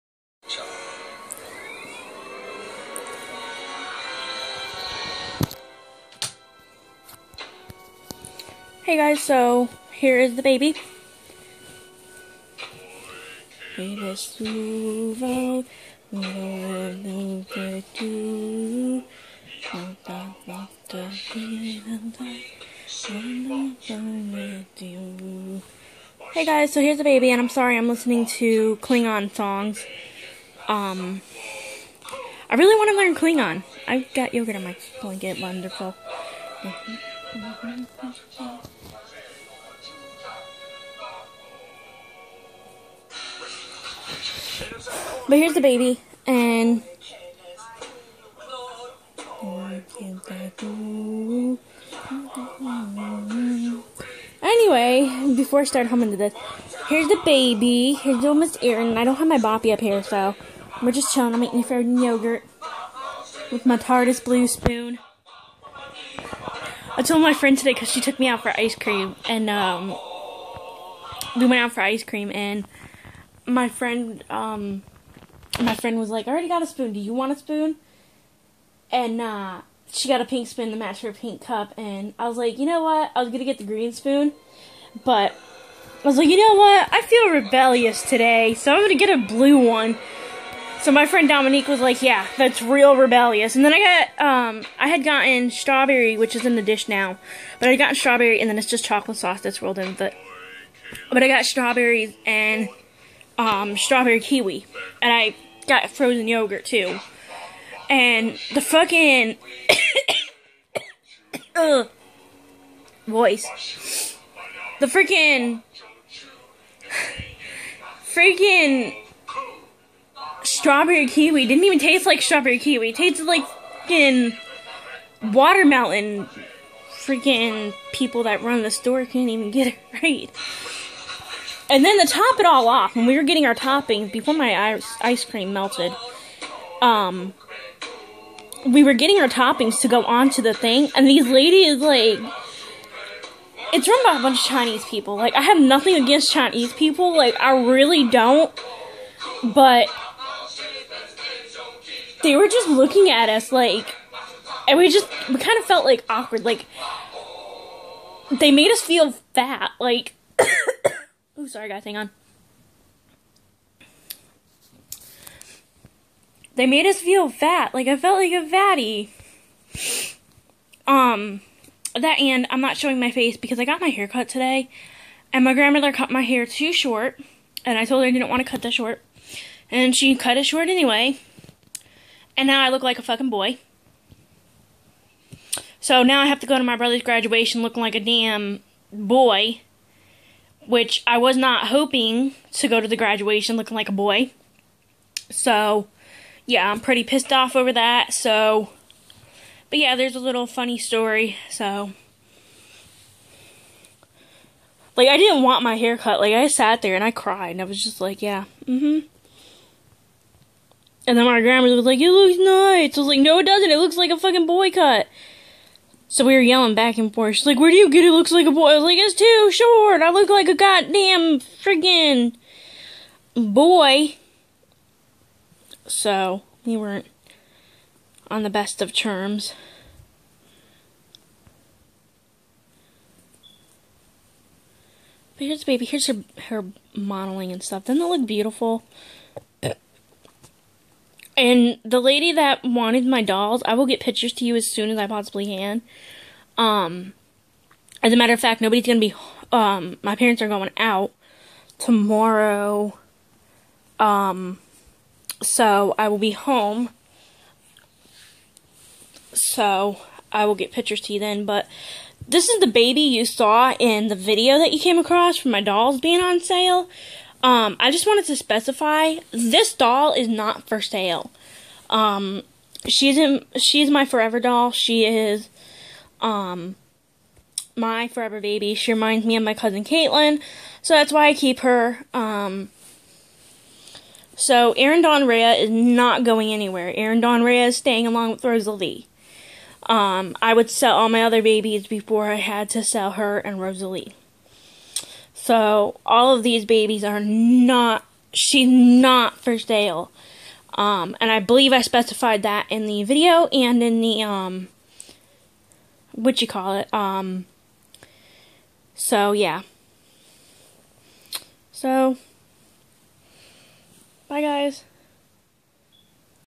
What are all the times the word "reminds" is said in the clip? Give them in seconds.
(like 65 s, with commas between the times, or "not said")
278 s.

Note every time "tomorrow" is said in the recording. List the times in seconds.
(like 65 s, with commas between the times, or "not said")
251 s.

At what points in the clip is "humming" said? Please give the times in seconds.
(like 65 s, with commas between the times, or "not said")
55 s.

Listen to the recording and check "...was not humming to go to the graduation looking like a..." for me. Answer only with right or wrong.
wrong.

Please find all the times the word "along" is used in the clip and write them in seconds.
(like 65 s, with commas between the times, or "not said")
288 s.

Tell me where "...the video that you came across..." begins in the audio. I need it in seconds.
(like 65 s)
264 s.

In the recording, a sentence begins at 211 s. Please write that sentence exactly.
And then my grandma was like, it looks nice.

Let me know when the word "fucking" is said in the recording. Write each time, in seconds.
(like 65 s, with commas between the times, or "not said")
108 s, 183 s, 214 s.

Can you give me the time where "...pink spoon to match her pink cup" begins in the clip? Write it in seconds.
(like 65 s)
80 s.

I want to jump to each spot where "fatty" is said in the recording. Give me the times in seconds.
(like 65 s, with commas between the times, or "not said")
168 s.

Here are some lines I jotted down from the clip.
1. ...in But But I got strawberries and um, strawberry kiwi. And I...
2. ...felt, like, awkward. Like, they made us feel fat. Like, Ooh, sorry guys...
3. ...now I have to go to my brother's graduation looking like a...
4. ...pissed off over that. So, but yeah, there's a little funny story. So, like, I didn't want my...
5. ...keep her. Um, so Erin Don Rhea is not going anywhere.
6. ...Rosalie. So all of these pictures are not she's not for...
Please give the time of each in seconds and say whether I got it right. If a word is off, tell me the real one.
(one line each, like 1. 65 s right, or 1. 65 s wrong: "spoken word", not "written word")
1. 99 s right
2. 155 s right
3. 186 s right
4. 197 s right
5. 281 s right
6. 293 s wrong: "babies", not "pictures".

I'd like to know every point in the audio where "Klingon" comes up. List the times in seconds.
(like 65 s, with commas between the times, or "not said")
28 s, 33 s.